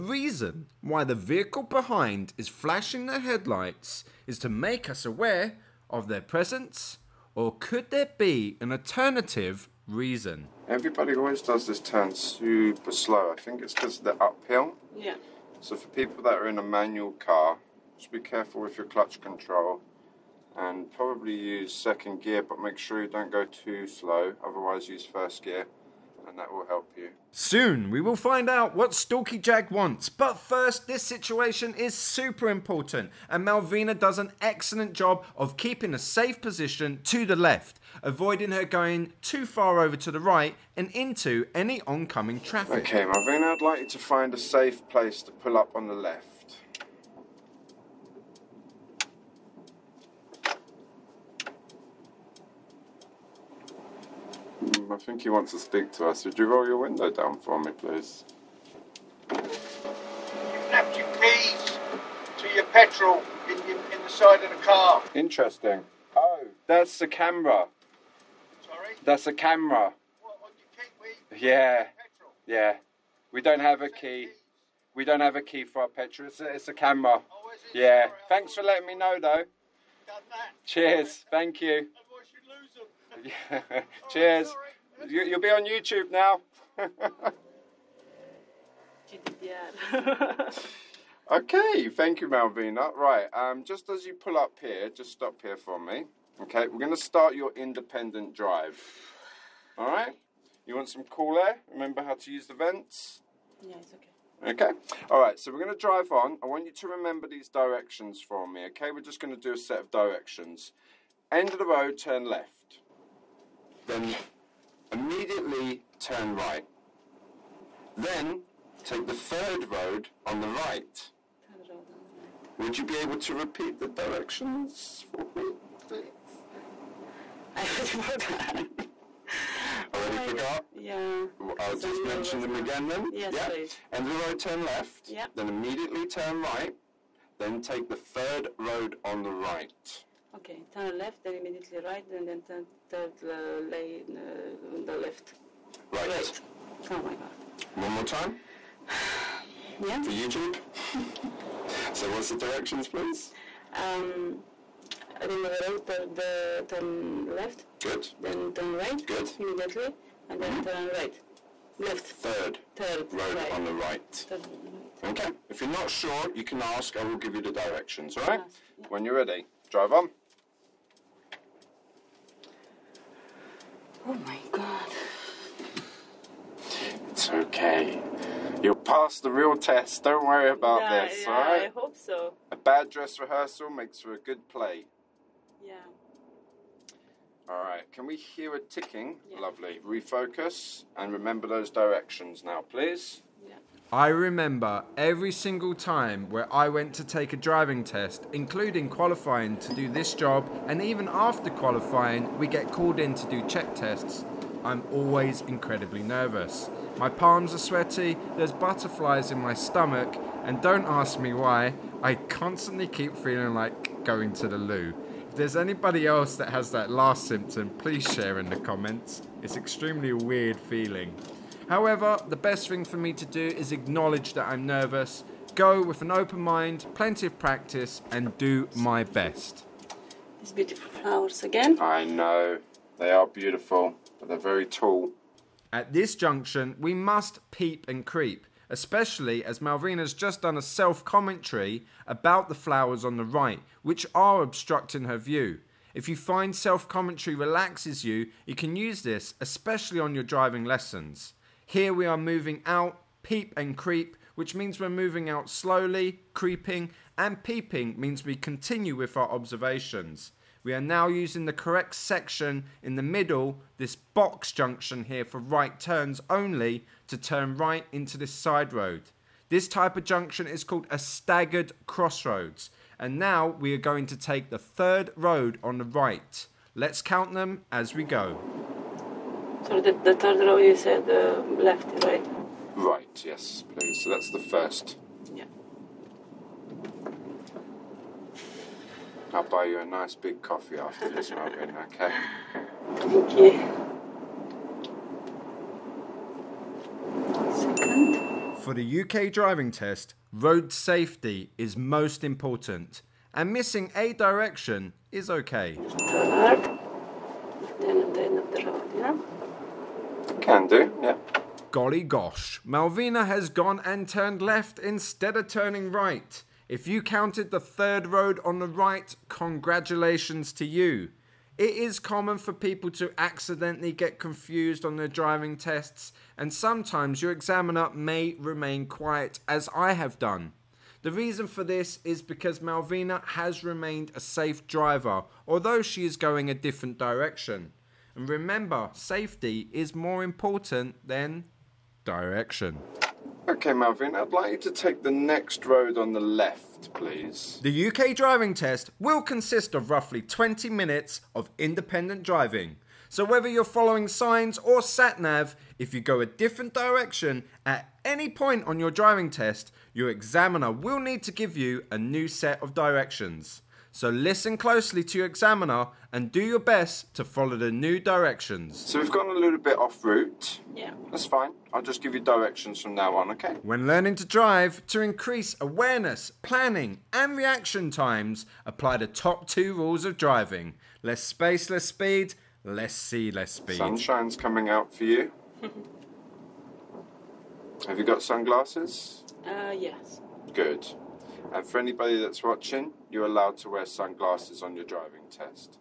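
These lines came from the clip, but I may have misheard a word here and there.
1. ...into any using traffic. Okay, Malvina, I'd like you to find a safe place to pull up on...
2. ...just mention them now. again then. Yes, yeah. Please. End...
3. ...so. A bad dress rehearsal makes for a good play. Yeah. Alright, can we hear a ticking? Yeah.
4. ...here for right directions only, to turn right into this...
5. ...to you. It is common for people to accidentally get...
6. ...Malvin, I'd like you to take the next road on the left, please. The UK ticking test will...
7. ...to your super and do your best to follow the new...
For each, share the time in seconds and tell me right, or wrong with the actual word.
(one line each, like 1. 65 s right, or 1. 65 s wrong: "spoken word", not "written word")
1. 40 s wrong: "oncoming", not "using"
2. 131 s right
3. 181 s right
4. 265 s wrong: "turns", not "directions"
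5. 320 s right
6. 343 s wrong: "driving", not "ticking"
7. 365 s wrong: "examiner", not "super".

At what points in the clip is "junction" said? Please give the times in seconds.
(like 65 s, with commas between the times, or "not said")
236 s, 264 s, 270 s.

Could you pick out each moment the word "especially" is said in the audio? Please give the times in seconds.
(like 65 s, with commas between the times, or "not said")
238 s, 249 s.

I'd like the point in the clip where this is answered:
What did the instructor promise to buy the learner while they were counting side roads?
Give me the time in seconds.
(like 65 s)
289 s.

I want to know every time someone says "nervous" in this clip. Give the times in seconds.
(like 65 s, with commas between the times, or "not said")
206 s, 224 s.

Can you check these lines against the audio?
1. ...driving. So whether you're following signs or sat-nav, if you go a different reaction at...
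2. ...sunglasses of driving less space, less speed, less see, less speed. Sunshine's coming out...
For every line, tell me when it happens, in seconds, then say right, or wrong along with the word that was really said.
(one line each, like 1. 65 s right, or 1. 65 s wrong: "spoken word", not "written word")
1. 352 s wrong: "direction", not "reaction"
2. 379 s wrong: "rules", not "sunglasses".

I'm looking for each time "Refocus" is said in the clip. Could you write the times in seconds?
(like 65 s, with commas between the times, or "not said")
189 s.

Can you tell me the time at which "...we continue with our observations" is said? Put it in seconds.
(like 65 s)
258 s.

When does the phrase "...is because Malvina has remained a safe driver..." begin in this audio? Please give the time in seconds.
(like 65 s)
332 s.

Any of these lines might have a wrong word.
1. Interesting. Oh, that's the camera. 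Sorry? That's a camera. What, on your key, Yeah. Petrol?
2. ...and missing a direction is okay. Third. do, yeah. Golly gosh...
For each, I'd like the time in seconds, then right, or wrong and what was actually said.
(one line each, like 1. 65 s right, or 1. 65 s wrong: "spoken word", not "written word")
1. 65 s right
2. 303 s right.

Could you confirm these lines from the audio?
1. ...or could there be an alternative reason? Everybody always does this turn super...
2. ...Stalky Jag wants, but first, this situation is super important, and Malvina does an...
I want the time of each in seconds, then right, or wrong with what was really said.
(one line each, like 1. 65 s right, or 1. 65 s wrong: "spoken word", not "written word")
1. 7 s right
2. 28 s right.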